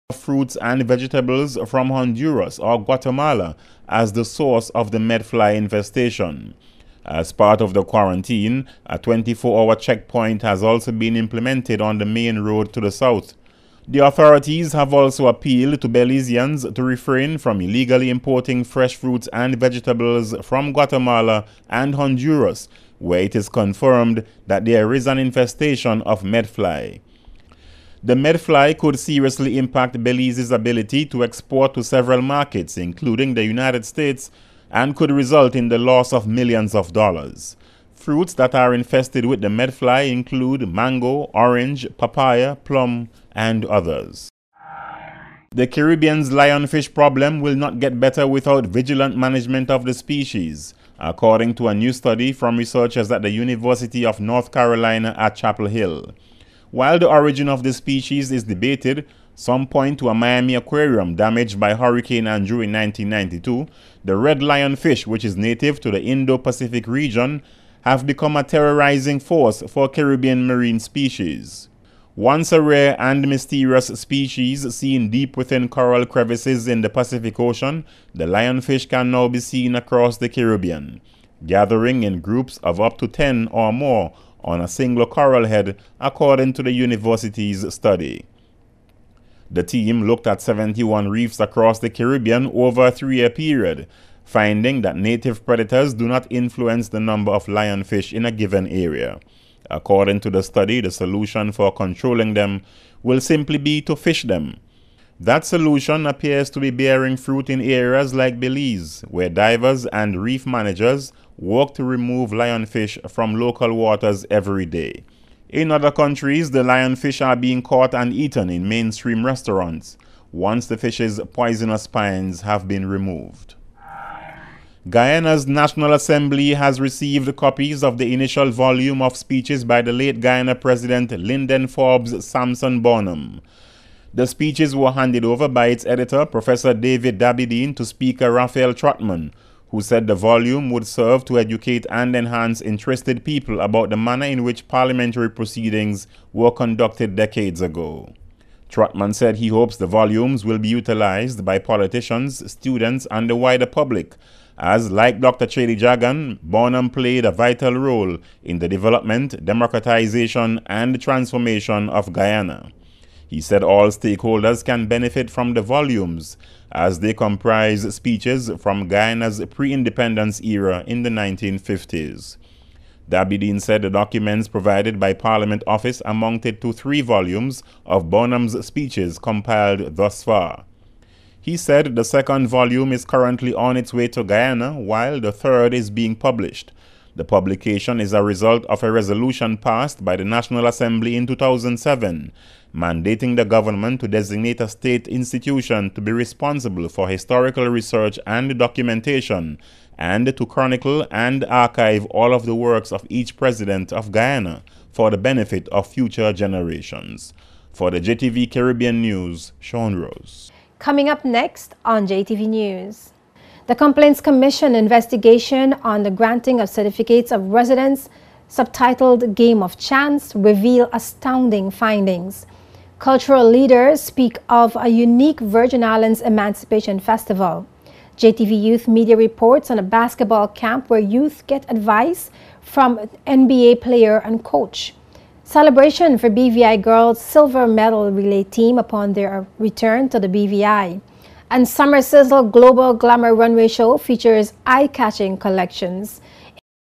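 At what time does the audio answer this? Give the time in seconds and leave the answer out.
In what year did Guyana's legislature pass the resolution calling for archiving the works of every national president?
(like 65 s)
191 s.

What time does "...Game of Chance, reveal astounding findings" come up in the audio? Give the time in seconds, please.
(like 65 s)
219 s.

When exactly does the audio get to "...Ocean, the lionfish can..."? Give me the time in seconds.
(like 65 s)
77 s.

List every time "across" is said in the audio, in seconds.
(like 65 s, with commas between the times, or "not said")
79 s, 91 s.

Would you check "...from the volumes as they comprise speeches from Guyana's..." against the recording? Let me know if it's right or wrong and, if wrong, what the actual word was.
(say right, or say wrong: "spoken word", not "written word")
right.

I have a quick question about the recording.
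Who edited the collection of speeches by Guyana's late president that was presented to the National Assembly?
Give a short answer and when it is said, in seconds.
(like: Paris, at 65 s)
David Dabydeen, at 136 s.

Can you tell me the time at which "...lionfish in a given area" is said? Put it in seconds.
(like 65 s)
97 s.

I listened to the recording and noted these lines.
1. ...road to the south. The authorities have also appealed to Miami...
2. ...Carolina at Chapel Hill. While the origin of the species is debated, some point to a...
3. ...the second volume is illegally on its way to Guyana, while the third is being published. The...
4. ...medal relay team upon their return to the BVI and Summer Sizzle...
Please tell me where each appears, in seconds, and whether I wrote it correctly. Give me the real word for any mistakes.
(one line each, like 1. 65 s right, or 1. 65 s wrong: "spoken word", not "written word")
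1. 12 s wrong: "Belizeans", not "Miami"
2. 54 s right
3. 181 s wrong: "currently", not "illegally"
4. 237 s right.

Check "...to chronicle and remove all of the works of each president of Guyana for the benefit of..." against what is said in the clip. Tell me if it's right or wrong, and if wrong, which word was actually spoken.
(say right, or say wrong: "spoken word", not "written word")
wrong: "archive", not "remove".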